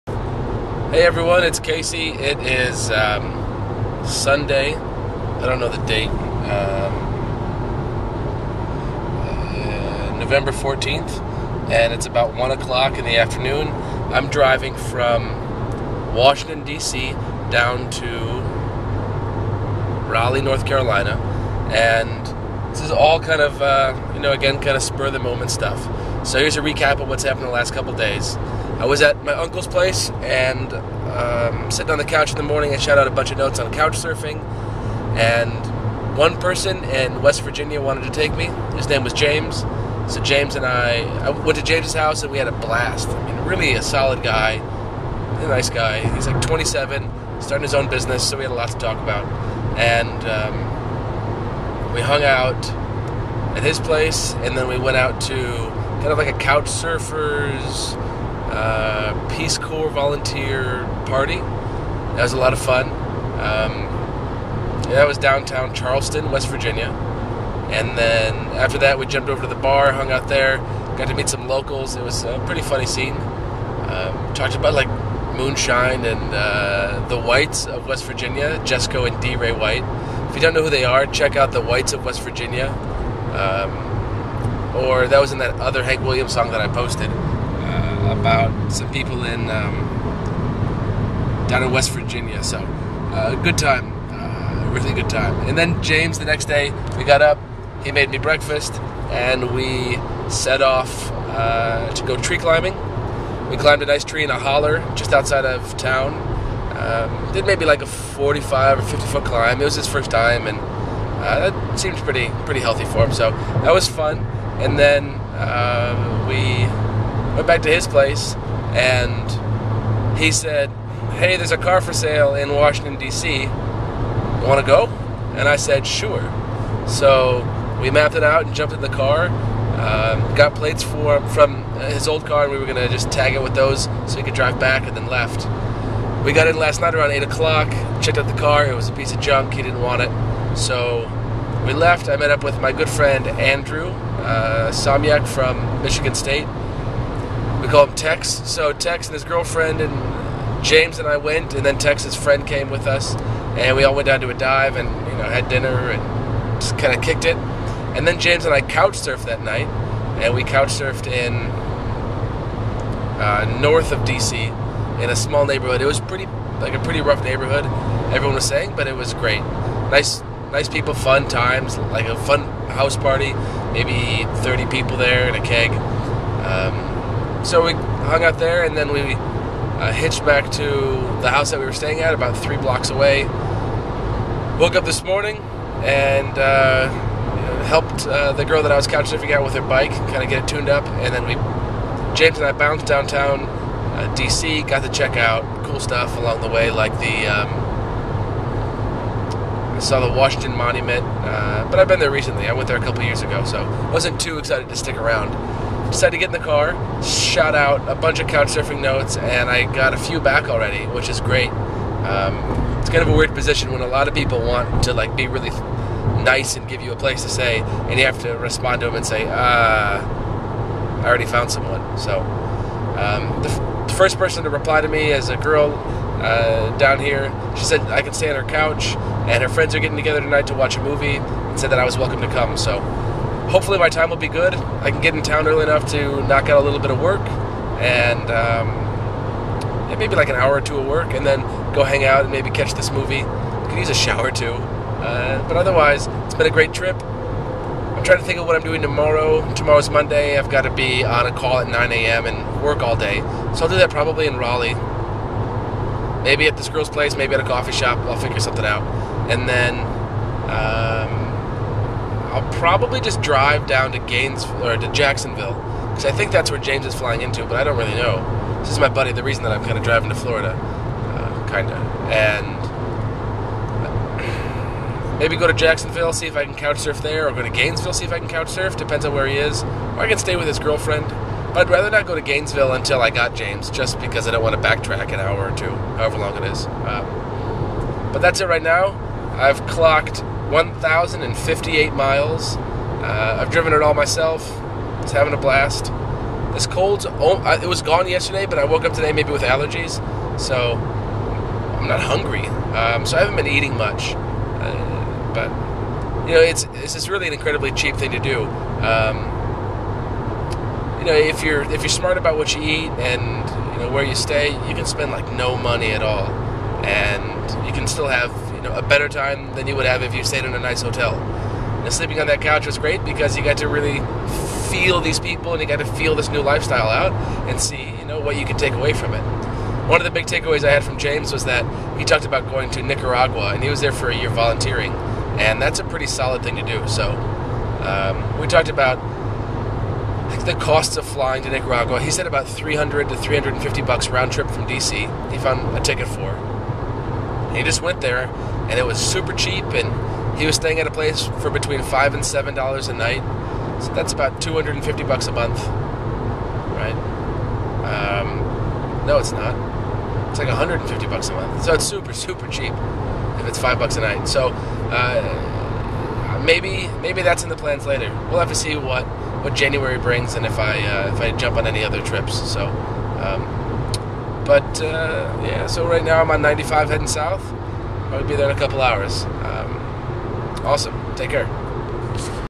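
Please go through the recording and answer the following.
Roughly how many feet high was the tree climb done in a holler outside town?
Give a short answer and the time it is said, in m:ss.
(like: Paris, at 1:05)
45 or 50 feet, at 1:47.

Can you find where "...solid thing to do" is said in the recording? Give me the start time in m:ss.
5:36.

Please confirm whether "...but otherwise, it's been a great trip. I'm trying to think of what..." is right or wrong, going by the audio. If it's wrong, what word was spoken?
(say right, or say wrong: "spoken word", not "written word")
right.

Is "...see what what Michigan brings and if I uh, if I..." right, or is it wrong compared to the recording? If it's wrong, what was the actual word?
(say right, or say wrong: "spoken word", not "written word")
wrong: "January", not "Michigan".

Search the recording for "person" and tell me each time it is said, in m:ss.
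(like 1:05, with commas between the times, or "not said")
0:36, 3:44.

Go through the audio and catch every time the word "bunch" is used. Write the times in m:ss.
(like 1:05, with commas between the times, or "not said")
0:33, 3:27.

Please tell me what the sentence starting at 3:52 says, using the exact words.
So hopefully my time will be good.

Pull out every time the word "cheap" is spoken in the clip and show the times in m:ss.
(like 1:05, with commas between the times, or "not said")
5:07, 5:49, 6:02.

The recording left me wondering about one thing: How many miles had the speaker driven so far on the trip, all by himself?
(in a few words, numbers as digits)
1,058.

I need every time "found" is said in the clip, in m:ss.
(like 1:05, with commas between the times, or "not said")
3:41, 5:45.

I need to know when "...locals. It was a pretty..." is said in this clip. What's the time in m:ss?
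1:11.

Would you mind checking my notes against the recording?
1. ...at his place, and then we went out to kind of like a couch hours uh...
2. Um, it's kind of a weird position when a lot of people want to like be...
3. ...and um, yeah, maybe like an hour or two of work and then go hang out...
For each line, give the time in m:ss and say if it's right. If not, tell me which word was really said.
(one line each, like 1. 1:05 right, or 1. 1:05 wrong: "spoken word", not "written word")
1. 0:53 wrong: "surfers", not "hours"
2. 3:31 right
3. 3:57 right.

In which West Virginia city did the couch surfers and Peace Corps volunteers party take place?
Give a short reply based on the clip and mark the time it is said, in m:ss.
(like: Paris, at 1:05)
Charleston, at 1:05.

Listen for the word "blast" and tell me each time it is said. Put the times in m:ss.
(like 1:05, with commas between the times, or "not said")
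0:42, 4:55.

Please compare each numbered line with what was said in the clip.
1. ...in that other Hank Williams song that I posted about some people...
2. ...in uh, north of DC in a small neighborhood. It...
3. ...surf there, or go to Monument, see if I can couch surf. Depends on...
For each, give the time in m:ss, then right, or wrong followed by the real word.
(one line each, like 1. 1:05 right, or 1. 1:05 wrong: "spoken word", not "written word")
1. 1:25 right
2. 2:41 right
3. 4:36 wrong: "Gainesville", not "Monument".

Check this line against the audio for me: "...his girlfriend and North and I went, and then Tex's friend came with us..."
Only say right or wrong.
wrong.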